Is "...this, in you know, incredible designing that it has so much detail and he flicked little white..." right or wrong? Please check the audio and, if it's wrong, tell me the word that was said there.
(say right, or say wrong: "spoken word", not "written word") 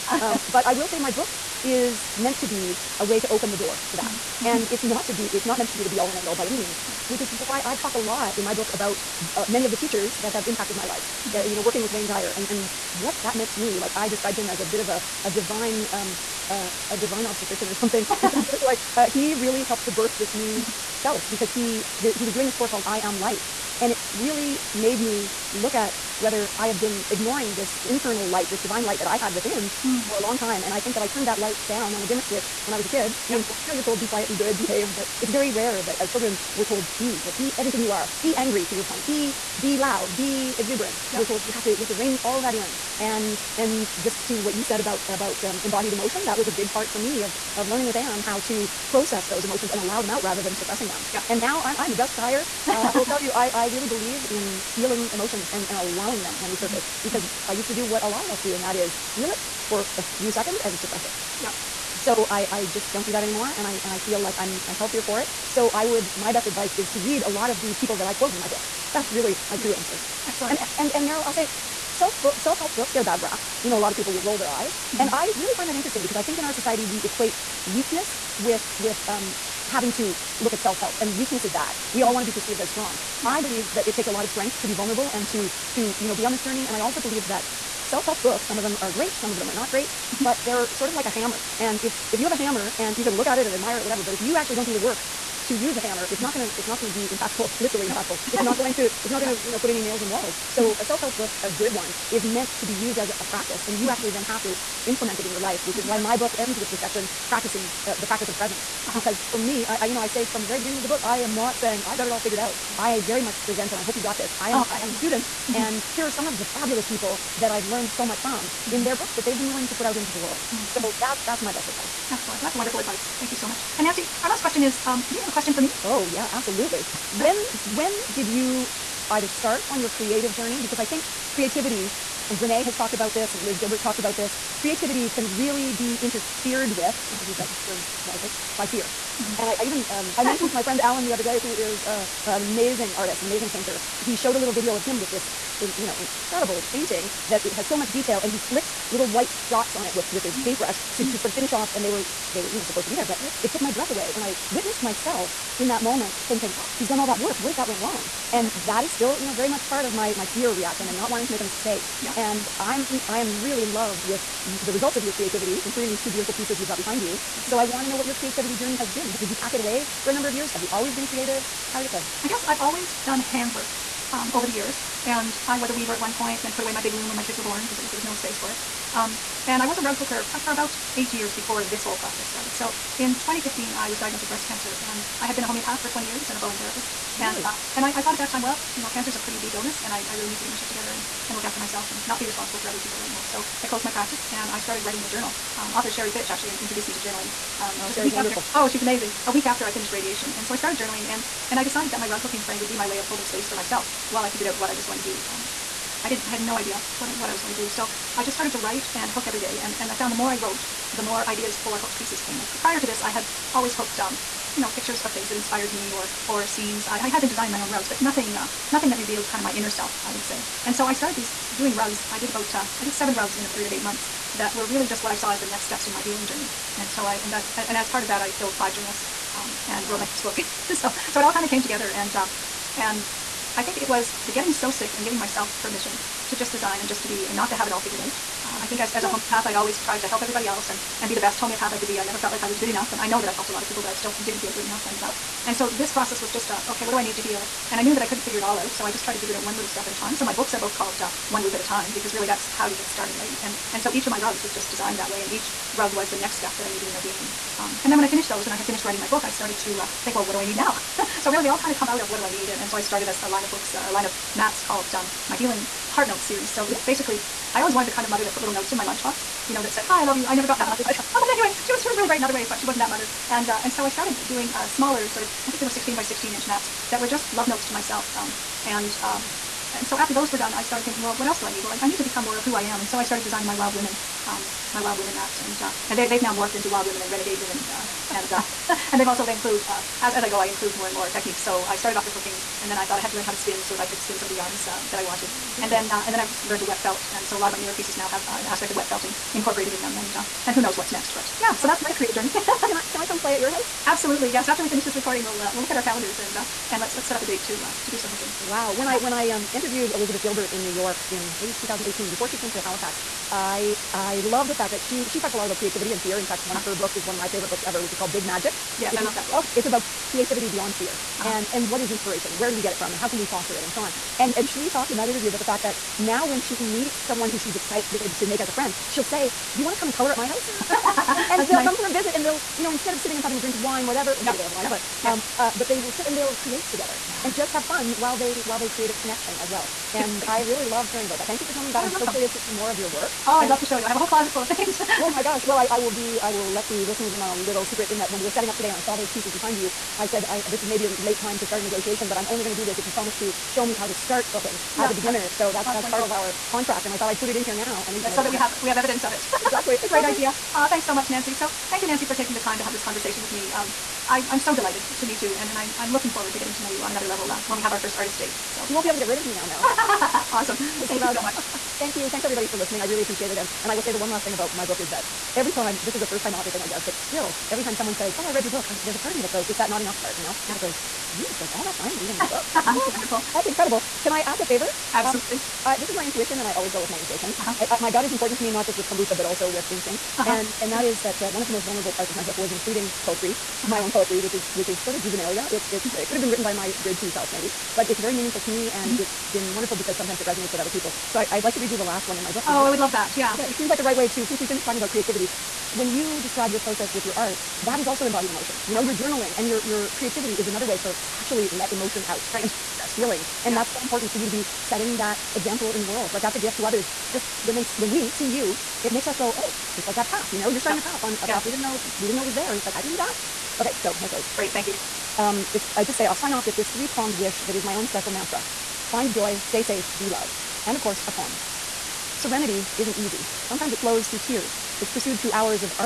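wrong: "painting", not "designing".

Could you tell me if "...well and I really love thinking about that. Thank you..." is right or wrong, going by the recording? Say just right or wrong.
wrong.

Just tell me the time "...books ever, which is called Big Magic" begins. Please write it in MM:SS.
05:17.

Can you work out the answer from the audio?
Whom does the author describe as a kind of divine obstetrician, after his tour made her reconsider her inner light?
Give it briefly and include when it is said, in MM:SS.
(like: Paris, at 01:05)
Wayne Dyer, at 00:11.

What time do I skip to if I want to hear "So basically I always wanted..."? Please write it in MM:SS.
04:26.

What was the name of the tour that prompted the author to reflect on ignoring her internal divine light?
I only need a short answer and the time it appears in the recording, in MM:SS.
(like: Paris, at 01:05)
I Am Light, at 00:22.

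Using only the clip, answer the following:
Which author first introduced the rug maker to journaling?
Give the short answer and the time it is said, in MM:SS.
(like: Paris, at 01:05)
Sheree Fitch, at 03:15.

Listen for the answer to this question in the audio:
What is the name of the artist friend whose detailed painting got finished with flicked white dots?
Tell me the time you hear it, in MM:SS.
02:20.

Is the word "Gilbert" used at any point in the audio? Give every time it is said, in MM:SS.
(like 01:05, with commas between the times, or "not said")
02:13, 05:10.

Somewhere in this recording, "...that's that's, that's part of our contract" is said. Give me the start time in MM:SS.
05:55.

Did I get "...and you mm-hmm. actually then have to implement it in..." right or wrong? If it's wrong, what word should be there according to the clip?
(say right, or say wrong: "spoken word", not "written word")
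right.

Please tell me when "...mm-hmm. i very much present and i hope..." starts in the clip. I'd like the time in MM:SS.
01:52.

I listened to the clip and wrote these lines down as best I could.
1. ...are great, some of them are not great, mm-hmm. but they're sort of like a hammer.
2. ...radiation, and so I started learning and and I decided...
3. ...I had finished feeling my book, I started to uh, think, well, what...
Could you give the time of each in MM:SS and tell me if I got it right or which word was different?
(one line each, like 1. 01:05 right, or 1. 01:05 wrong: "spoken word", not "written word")
1. 01:28 right
2. 03:19 wrong: "journaling", not "learning"
3. 04:18 wrong: "writing", not "feeling".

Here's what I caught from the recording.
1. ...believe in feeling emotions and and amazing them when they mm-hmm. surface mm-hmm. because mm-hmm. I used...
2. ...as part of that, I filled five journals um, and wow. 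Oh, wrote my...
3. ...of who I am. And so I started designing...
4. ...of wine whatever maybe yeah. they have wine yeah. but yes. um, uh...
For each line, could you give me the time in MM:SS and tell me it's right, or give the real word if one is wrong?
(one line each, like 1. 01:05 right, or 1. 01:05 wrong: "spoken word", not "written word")
1. 00:53 wrong: "allowing", not "amazing"
2. 03:47 right
3. 04:42 right
4. 05:33 right.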